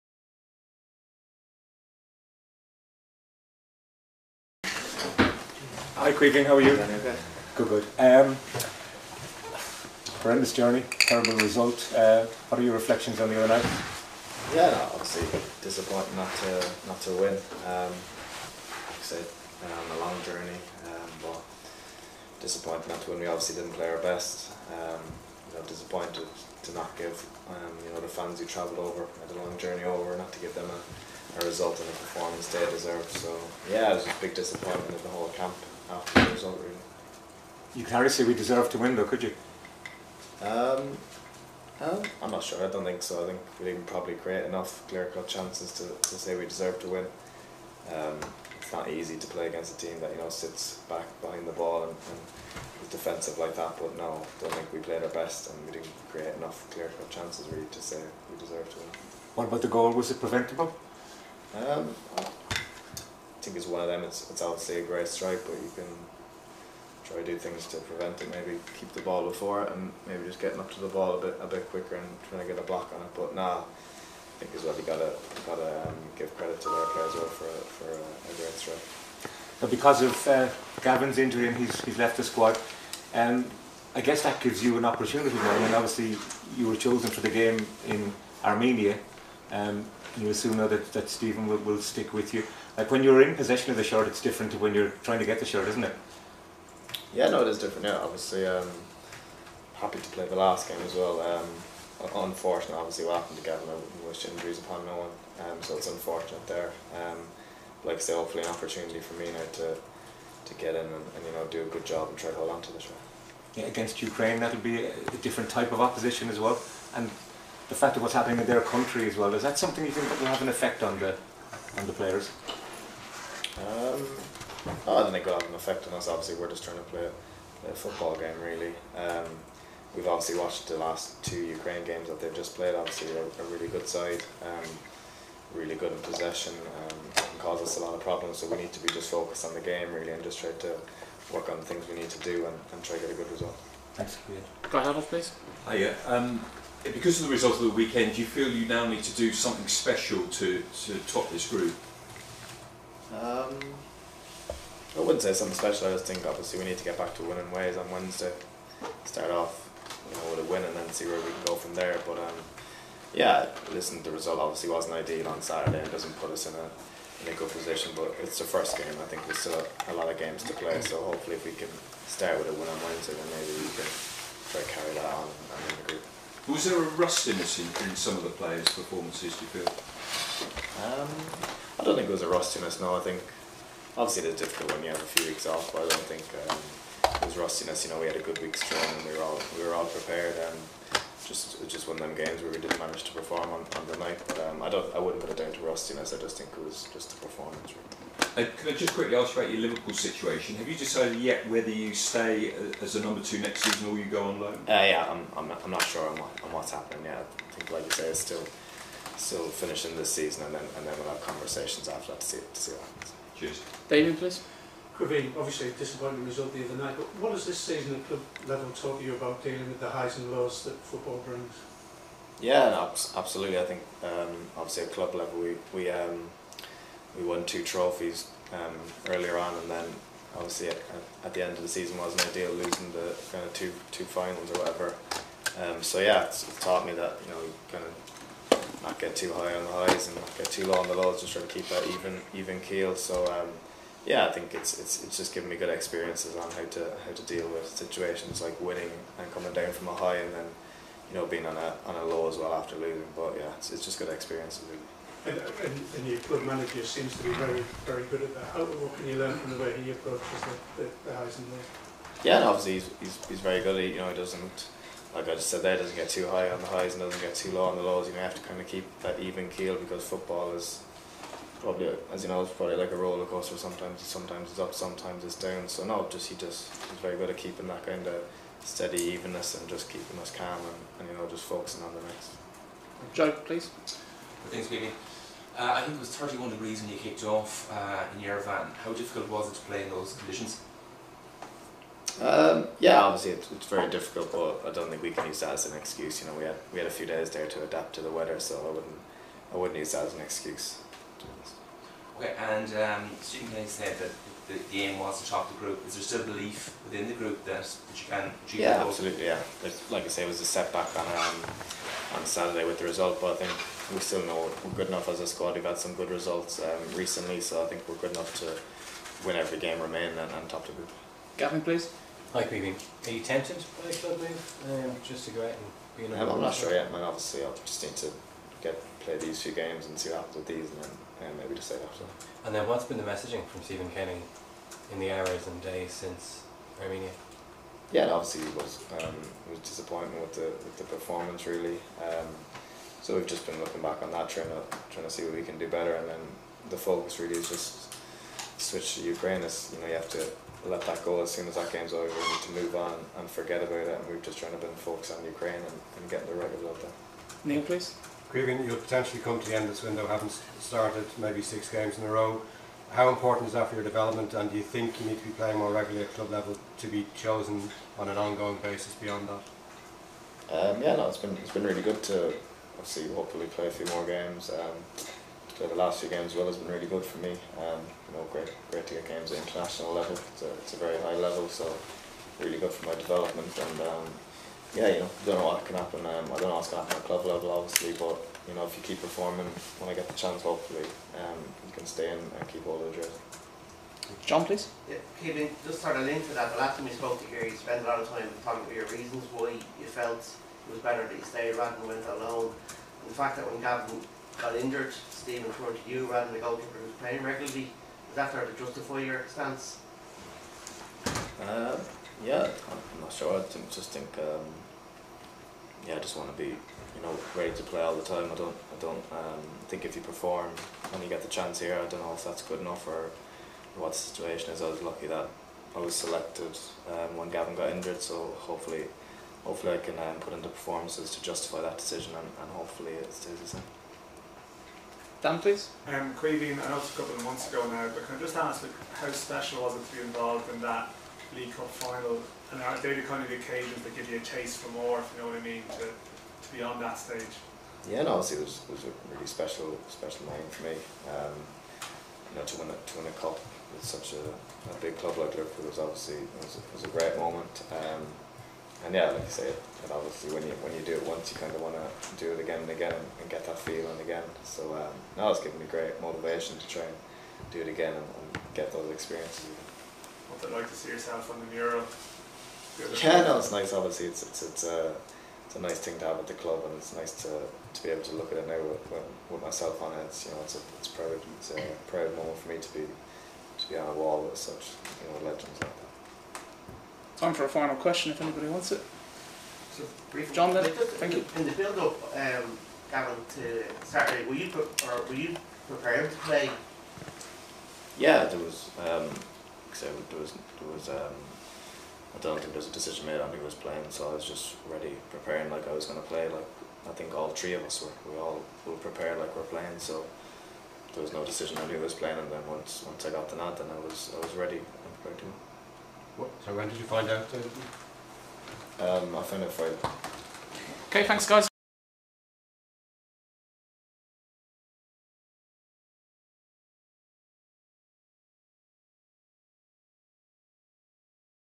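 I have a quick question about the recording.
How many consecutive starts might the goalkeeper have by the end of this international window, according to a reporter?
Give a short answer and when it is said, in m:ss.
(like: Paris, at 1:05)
6, at 6:01.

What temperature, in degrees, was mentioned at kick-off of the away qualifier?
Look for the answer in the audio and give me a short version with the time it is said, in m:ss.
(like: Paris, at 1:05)
31, at 4:46.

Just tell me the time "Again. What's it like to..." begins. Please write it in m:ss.
7:49.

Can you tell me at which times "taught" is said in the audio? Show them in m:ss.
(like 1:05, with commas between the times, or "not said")
3:38, 3:56.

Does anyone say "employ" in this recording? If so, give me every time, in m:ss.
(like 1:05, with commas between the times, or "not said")
not said.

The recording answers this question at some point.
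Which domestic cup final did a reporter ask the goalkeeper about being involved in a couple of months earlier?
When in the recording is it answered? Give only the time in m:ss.
7:21.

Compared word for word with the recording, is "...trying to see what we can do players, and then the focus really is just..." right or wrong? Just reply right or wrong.
wrong.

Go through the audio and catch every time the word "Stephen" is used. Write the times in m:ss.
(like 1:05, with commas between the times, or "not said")
1:31, 5:03, 5:33, 6:45.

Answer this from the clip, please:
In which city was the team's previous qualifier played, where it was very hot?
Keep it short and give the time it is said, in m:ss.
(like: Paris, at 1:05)
Yerevan, at 4:48.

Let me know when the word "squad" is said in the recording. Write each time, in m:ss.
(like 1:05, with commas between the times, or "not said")
1:22, 5:15.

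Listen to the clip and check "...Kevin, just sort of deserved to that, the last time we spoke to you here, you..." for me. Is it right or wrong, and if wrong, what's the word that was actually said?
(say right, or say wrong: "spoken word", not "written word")
wrong: "linked", not "deserved".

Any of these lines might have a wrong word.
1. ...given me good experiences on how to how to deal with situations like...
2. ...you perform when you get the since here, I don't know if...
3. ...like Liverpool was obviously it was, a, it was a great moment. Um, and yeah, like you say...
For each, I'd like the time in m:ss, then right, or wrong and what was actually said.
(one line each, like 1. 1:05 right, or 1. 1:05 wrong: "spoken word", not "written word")
1. 4:05 right
2. 6:59 wrong: "chance", not "since"
3. 7:35 right.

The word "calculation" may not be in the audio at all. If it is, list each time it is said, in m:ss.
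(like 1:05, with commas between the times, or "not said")
not said.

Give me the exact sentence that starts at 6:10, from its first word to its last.
Um, yeah, no, it's been it's been really good to obviously hopefully play a few more games.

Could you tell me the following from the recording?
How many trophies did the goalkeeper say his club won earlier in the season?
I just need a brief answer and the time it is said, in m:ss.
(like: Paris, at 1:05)
2, at 3:47.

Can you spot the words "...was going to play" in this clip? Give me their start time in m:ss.
8:25.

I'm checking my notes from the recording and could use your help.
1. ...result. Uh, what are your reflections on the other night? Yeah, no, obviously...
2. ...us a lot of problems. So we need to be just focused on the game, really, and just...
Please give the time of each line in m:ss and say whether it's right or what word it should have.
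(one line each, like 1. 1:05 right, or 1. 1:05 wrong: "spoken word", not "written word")
1. 0:11 right
2. 2:17 right.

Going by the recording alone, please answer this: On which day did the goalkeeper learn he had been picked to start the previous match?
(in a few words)
Friday.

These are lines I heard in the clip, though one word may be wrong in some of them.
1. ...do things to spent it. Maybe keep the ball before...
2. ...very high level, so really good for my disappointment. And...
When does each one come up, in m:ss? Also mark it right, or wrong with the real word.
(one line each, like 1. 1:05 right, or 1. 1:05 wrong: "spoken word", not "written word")
1. 1:07 wrong: "prevent", not "spent"
2. 6:20 wrong: "development", not "disappointment".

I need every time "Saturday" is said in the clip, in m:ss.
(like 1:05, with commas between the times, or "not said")
2:45, 5:12, 8:13.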